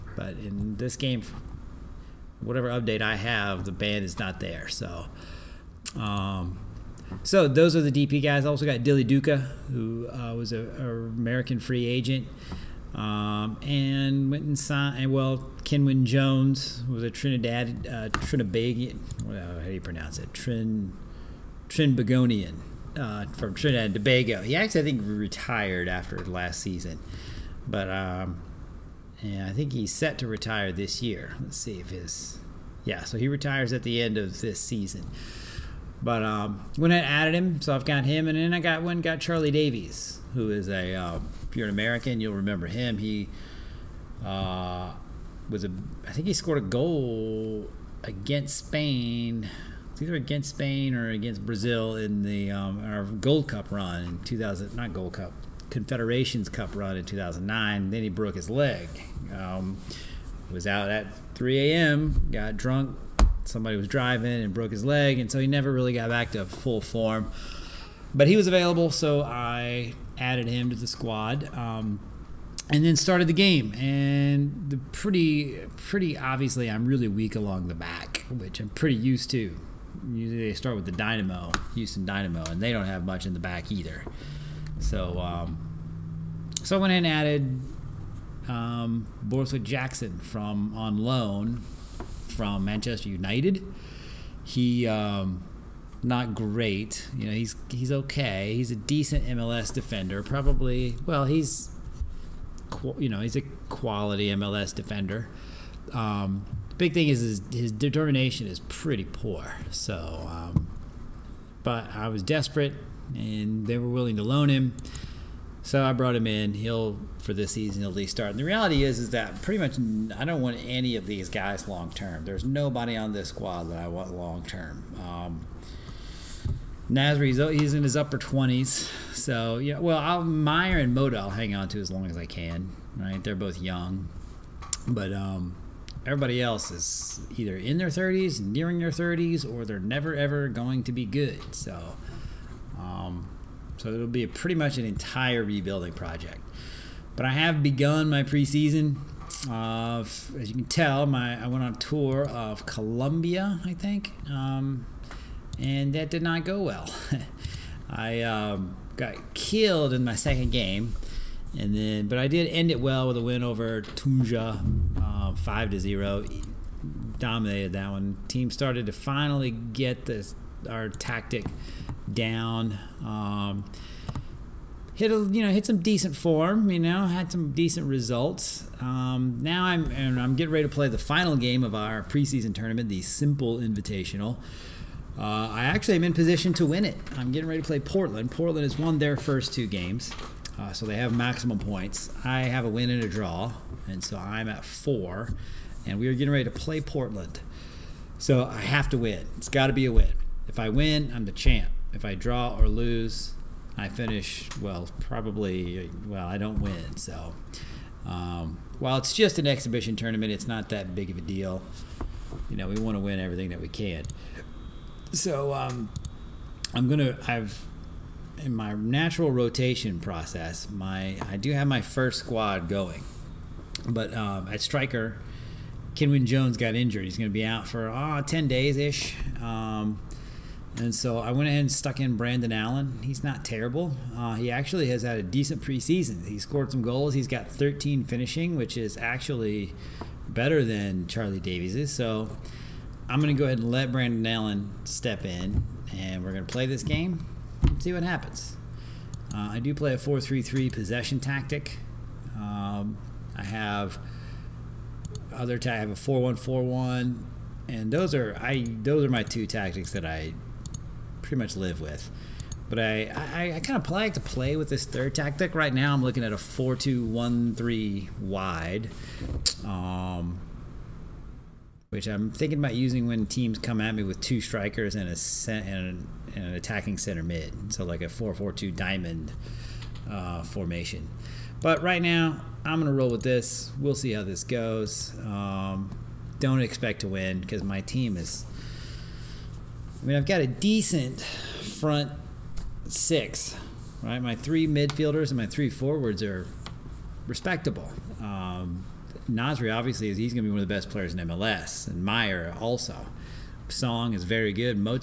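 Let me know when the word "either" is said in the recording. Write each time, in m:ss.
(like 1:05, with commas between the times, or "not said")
0:50, 1:23, 2:17.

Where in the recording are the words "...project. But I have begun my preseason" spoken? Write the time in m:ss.
2:25.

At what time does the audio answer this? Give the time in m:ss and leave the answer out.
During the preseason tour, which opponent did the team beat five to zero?
2:43.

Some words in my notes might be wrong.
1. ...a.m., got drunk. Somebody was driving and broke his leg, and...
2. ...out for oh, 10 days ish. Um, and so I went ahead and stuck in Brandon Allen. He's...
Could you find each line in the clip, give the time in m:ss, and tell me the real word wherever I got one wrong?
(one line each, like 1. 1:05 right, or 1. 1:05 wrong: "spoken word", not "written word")
1. 1:01 right
2. 3:47 right.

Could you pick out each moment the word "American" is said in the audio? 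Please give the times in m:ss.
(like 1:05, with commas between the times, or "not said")
0:10, 0:41.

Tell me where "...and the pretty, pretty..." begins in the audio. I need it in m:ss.
1:13.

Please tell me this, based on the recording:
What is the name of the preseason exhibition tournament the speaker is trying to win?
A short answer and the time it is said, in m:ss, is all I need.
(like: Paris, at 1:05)
Simple Invitational, at 3:03.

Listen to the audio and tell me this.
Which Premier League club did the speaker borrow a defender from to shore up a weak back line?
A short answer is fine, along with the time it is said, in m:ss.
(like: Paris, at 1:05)
Manchester United, at 1:32.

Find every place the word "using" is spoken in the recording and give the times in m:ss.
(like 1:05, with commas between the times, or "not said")
4:32.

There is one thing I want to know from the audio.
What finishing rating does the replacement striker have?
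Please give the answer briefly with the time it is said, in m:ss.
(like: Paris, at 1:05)
13, at 3:57.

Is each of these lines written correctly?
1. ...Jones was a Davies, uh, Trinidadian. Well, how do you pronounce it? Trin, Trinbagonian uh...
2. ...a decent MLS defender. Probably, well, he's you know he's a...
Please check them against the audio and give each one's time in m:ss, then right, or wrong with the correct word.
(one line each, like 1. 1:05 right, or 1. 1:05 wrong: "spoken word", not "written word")
1. 0:16 wrong: "Trinidad", not "Davies"
2. 1:38 right.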